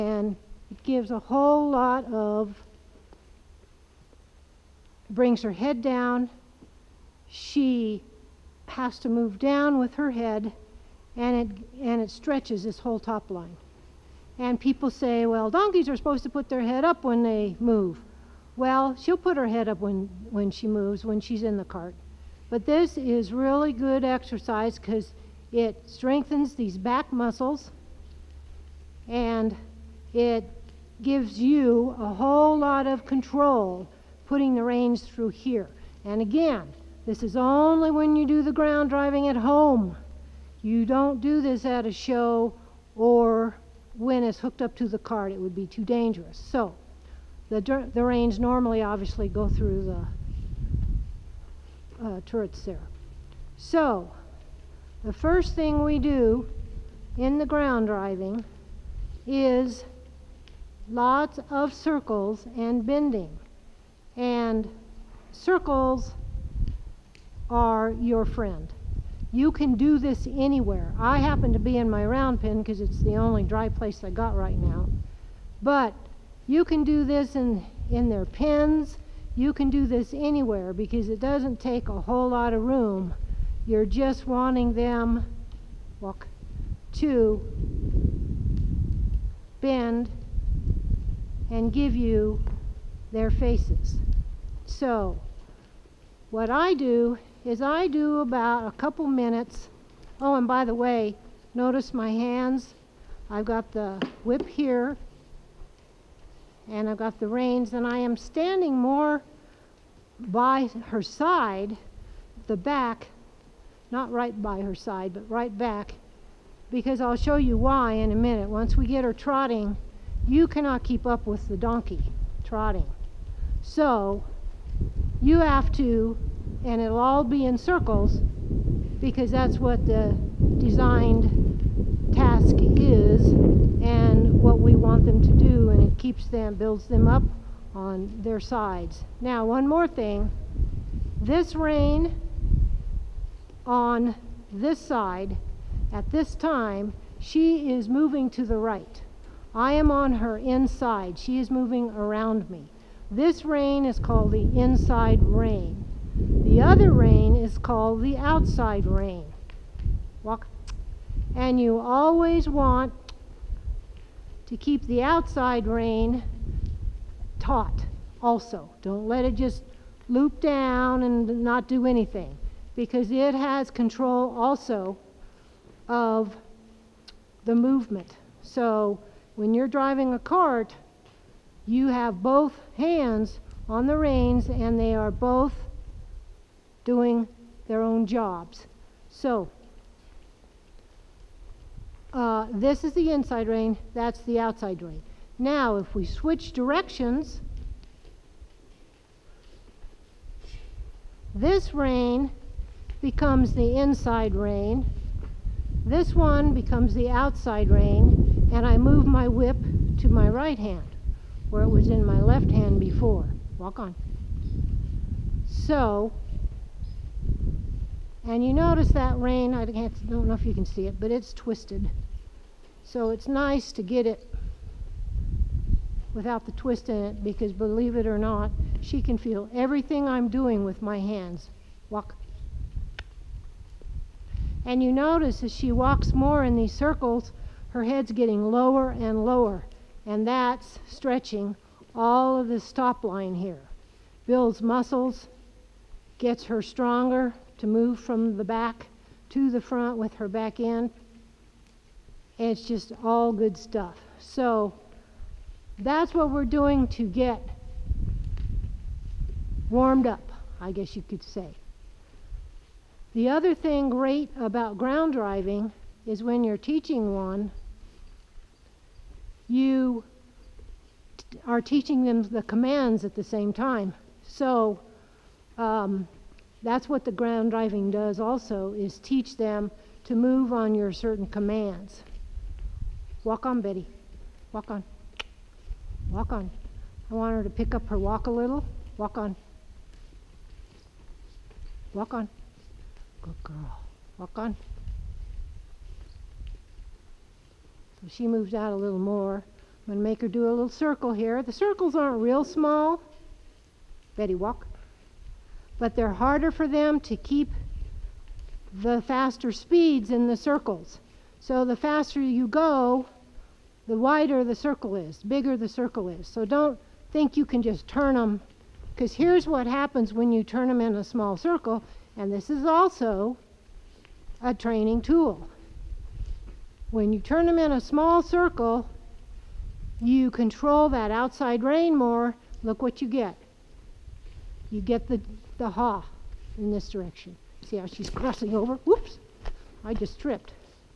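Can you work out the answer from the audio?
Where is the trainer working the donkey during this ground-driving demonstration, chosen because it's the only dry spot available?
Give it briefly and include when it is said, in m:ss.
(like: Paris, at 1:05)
Round pen, at 1:12.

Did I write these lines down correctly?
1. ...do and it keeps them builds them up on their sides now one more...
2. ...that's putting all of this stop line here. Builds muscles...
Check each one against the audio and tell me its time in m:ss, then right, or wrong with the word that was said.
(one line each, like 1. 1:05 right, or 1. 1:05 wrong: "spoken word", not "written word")
1. 2:15 right
2. 4:00 wrong: "stretching", not "putting".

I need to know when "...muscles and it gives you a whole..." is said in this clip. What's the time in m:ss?
0:27.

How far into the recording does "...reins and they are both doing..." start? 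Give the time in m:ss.
3:03.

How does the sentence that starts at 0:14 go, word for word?
And people say, well, donkeys are supposed to put their head up when they move.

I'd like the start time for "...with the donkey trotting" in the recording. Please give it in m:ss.
2:01.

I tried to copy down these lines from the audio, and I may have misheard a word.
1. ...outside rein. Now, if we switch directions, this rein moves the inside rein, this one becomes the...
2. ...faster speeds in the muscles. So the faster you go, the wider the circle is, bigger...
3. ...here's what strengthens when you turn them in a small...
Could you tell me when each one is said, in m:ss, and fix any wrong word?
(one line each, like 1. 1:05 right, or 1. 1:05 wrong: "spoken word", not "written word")
1. 3:14 wrong: "becomes", not "moves"
2. 5:09 wrong: "circles", not "muscles"
3. 5:19 wrong: "happens", not "strengthens".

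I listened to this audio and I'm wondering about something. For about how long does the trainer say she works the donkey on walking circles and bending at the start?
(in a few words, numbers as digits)
A couple minutes.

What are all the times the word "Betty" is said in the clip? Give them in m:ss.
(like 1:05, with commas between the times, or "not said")
4:43, 5:04.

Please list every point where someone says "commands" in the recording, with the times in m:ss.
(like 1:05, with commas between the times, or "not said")
4:32, 4:41.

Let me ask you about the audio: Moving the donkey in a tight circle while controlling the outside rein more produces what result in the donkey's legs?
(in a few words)
Crossing over.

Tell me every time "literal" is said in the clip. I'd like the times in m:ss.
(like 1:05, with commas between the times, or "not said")
not said.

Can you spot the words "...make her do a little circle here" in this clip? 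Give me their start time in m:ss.
5:00.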